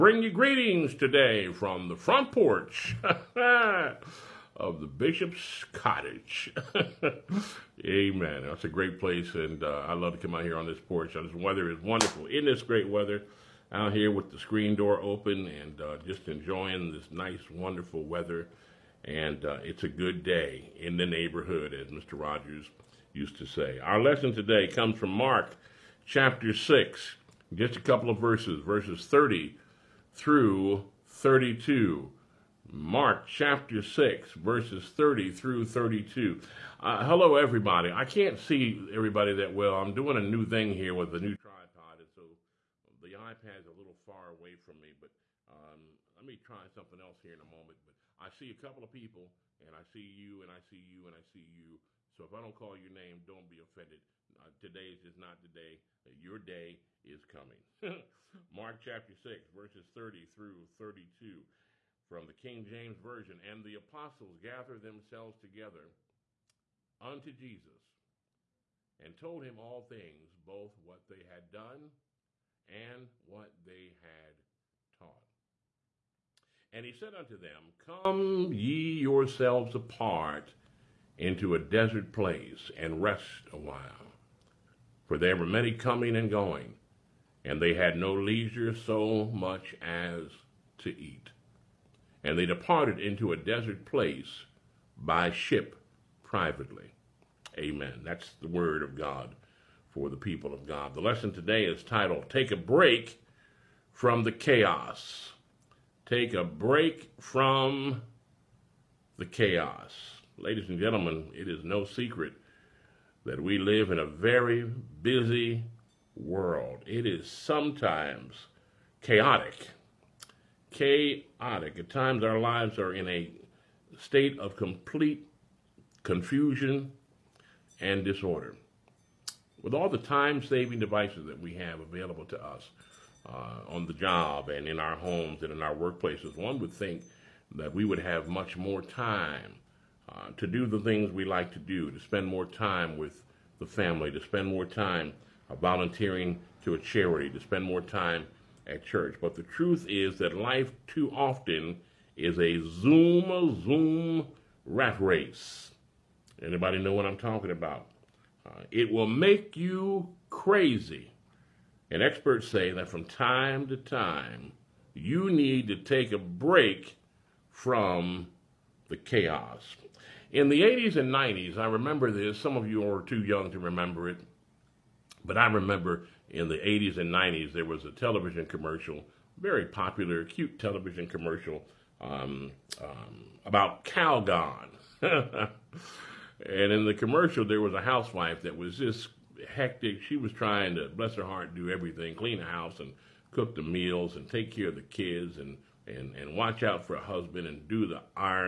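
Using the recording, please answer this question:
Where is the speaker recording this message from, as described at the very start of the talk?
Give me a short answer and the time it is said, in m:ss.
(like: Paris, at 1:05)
Bishop's Cottage, at 0:04.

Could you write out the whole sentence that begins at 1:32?
And they departed into a desert place by ship privately.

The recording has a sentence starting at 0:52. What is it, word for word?
So if I don't call your name, don't be offended.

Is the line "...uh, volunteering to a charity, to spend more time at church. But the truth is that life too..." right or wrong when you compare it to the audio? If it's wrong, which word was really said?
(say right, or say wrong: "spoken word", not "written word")
right.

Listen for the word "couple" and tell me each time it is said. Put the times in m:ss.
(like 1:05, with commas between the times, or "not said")
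0:27, 0:48.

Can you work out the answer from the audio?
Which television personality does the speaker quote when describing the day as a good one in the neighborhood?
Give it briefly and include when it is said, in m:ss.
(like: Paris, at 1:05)
Mr. Rogers, at 0:21.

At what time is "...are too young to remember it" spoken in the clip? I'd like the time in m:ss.
2:52.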